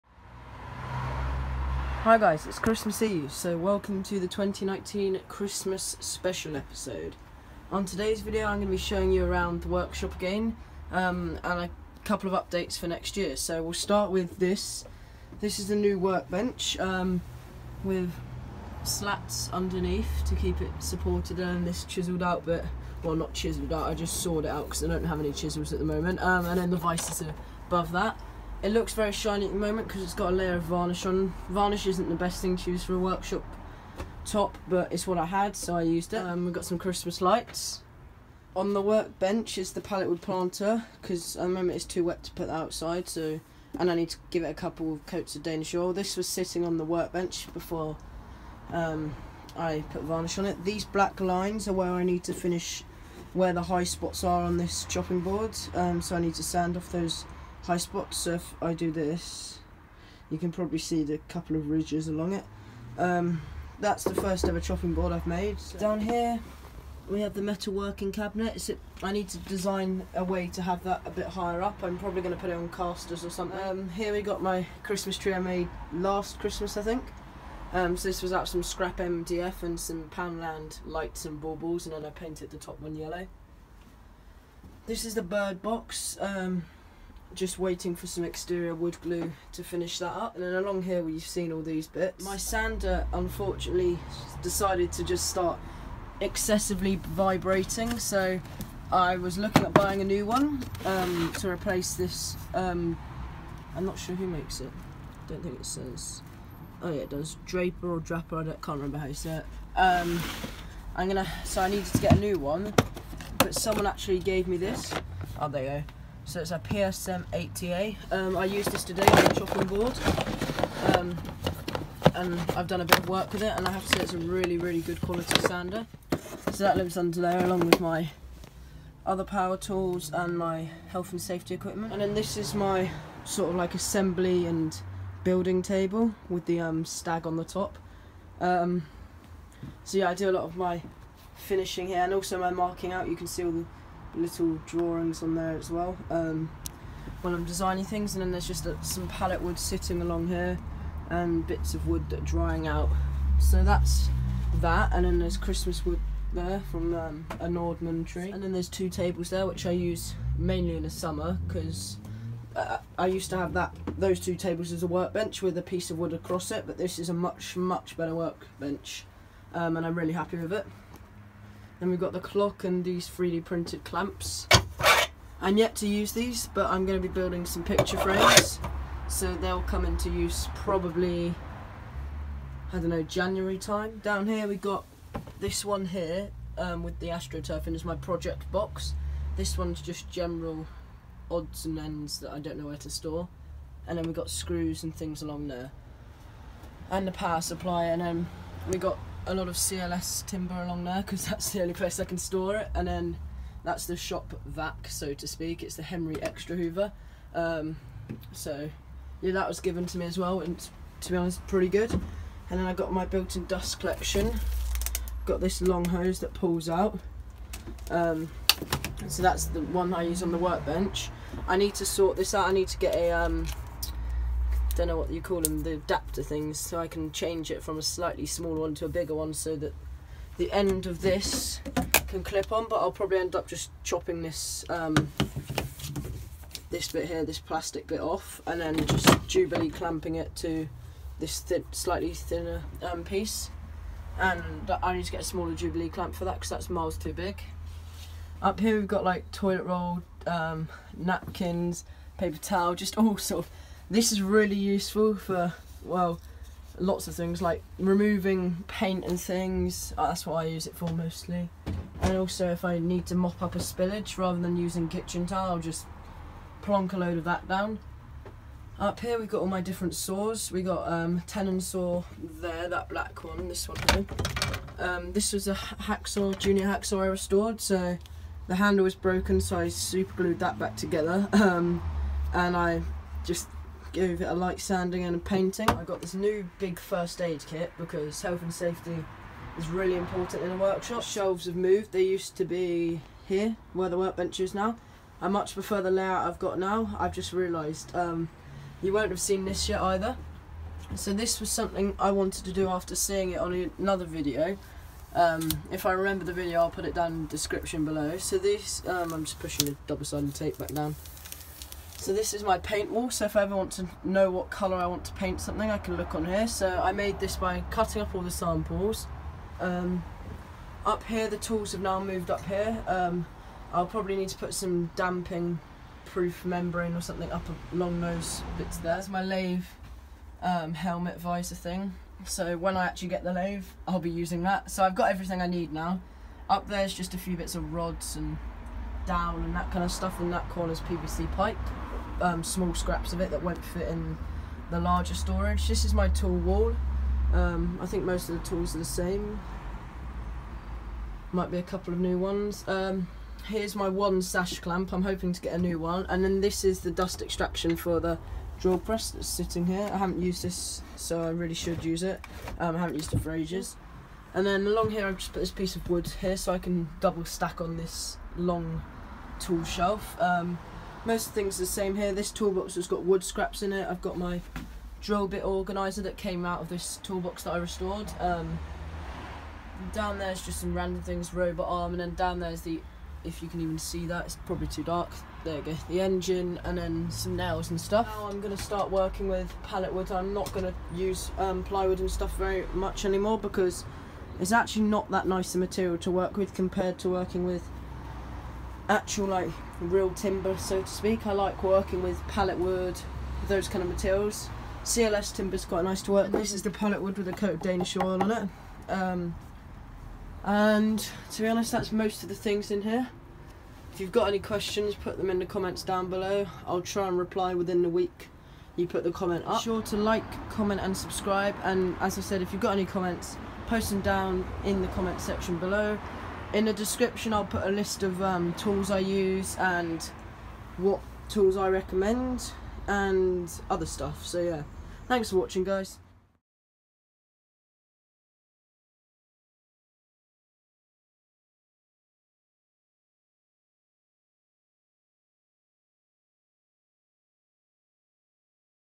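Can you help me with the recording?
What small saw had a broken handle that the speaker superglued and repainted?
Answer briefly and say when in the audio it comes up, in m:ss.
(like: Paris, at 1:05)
Junior hacksaw, at 4:36.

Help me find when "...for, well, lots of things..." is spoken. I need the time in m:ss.
4:15.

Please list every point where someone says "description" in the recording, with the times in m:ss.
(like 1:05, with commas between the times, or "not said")
5:07, 7:06.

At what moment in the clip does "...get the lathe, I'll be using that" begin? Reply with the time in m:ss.
5:33.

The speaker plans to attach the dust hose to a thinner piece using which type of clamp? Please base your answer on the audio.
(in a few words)
Jubilee clamp.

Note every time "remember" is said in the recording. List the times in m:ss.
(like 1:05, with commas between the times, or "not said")
1:48, 5:05.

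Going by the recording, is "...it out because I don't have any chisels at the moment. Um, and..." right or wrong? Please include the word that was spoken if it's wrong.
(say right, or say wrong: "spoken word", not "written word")
right.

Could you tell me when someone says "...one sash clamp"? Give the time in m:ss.
5:53.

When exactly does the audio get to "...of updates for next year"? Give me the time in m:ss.
0:12.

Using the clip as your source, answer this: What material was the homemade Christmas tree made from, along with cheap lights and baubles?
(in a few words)
scrap MDF.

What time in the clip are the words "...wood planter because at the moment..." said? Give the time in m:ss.
0:40.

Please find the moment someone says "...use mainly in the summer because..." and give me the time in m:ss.
2:39.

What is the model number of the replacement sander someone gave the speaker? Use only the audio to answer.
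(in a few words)
PSM 80A.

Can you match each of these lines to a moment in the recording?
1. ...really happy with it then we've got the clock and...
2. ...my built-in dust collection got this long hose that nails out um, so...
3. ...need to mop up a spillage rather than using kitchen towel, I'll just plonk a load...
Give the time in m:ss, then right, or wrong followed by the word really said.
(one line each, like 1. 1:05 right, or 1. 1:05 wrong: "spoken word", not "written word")
1. 2:49 right
2. 3:32 wrong: "pulls", not "nails"
3. 4:22 right.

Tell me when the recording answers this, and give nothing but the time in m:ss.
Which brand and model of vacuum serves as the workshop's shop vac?
3:25.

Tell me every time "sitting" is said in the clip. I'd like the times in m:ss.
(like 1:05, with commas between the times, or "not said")
0:46, 2:29, 5:59.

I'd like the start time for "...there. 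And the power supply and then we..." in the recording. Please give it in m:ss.
3:15.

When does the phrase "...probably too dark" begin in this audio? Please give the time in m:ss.
6:24.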